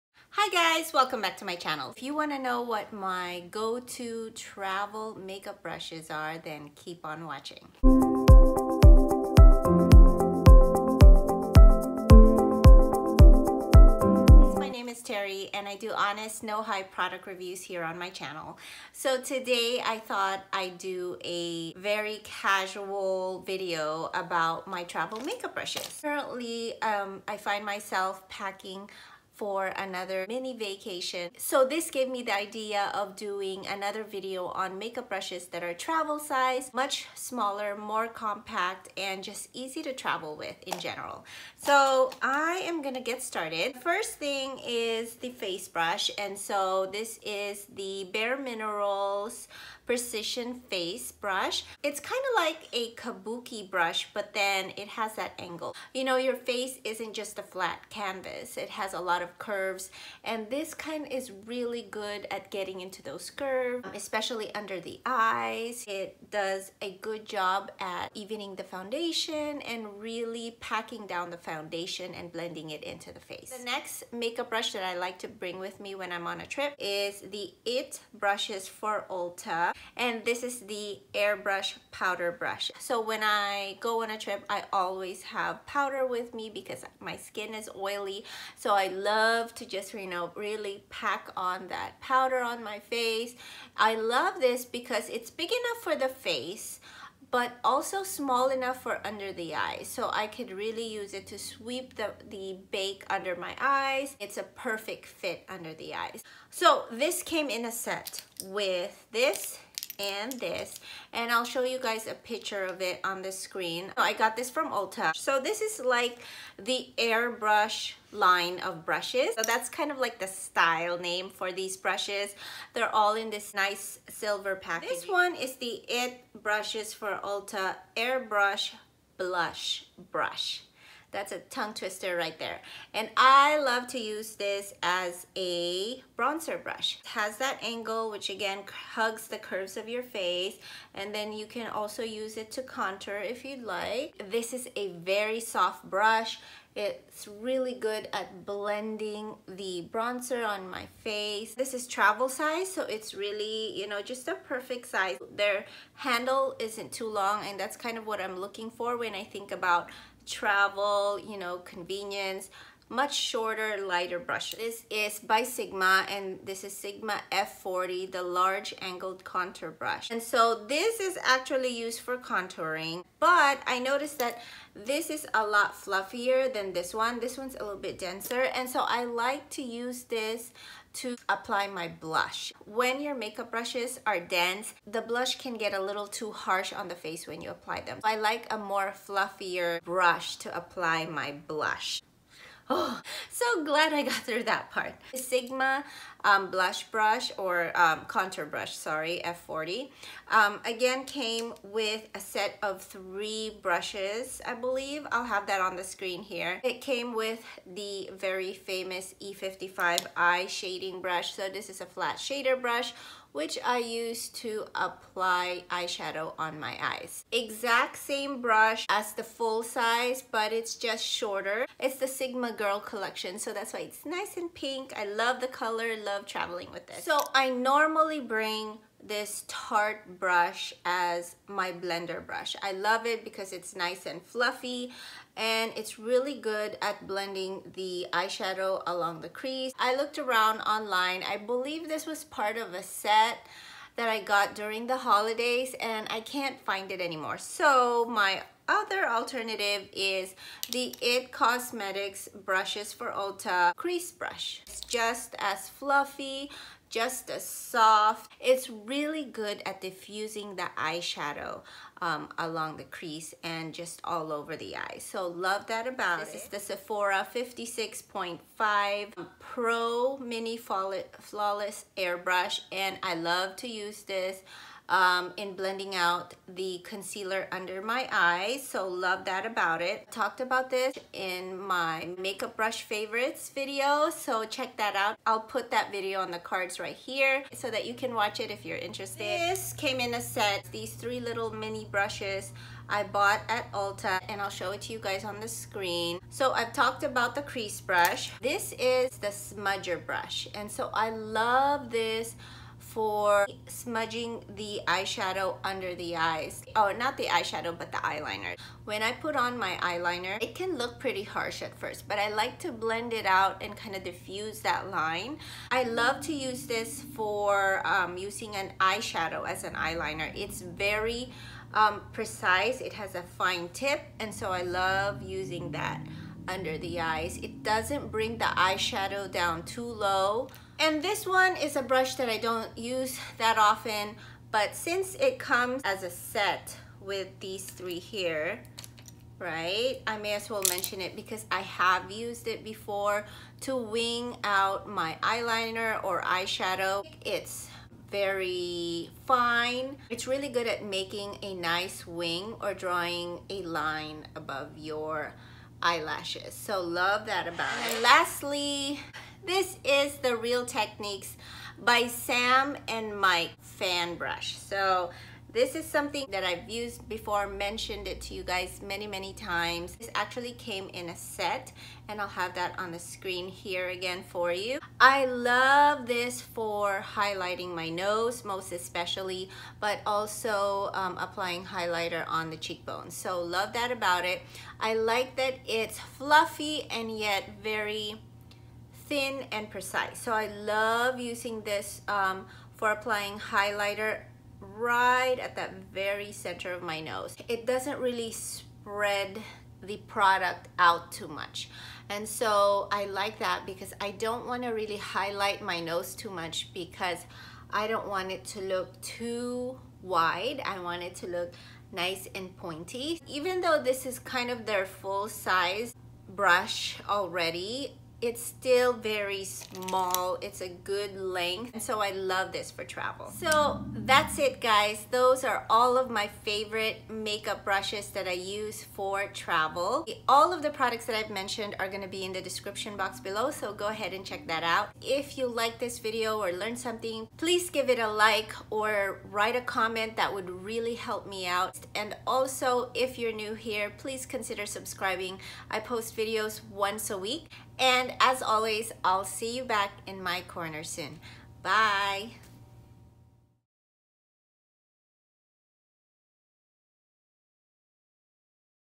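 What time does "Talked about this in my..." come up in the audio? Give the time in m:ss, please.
4:40.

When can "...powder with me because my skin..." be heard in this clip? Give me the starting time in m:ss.
1:25.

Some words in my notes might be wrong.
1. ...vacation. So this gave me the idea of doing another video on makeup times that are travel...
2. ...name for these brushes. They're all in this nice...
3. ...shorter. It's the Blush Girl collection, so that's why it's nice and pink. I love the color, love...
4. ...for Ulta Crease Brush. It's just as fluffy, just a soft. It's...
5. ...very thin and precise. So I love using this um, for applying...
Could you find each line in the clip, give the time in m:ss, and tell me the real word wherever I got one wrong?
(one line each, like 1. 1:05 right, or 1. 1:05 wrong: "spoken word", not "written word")
1. 0:30 wrong: "brushes", not "times"
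2. 2:00 right
3. 3:41 wrong: "Sigma", not "Blush"
4. 4:12 right
5. 6:27 right.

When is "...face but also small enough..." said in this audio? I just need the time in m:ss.
1:36.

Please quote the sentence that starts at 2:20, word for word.
And then you can also use it to contour if you'd like.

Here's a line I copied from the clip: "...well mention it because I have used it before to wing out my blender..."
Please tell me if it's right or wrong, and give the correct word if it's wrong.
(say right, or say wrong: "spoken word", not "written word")
wrong: "eyeliner", not "blender".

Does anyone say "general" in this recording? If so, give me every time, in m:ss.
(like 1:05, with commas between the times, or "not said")
0:40.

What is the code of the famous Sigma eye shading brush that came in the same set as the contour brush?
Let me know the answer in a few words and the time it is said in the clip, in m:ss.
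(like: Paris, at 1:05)
E55, at 3:29.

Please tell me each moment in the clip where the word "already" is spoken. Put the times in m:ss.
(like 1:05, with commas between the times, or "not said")
6:57.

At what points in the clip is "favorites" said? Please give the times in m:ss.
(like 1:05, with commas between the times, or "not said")
4:42, 7:06.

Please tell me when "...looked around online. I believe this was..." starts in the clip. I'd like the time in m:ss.
3:59.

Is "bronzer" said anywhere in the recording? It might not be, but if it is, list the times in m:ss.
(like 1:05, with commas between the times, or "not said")
2:16, 2:29.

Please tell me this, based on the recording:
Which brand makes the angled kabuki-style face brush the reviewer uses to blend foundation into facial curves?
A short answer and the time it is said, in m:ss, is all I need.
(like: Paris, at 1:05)
Bare Minerals, at 0:48.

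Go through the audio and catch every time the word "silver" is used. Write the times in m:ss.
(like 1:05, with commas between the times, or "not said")
2:04.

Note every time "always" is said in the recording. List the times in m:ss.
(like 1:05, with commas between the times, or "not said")
1:24, 7:28.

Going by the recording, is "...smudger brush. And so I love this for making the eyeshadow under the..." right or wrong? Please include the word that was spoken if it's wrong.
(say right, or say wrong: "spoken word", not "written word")
wrong: "smudging", not "making".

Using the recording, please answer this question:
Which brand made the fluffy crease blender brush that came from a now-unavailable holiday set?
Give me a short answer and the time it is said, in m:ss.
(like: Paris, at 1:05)
Tarte, at 3:49.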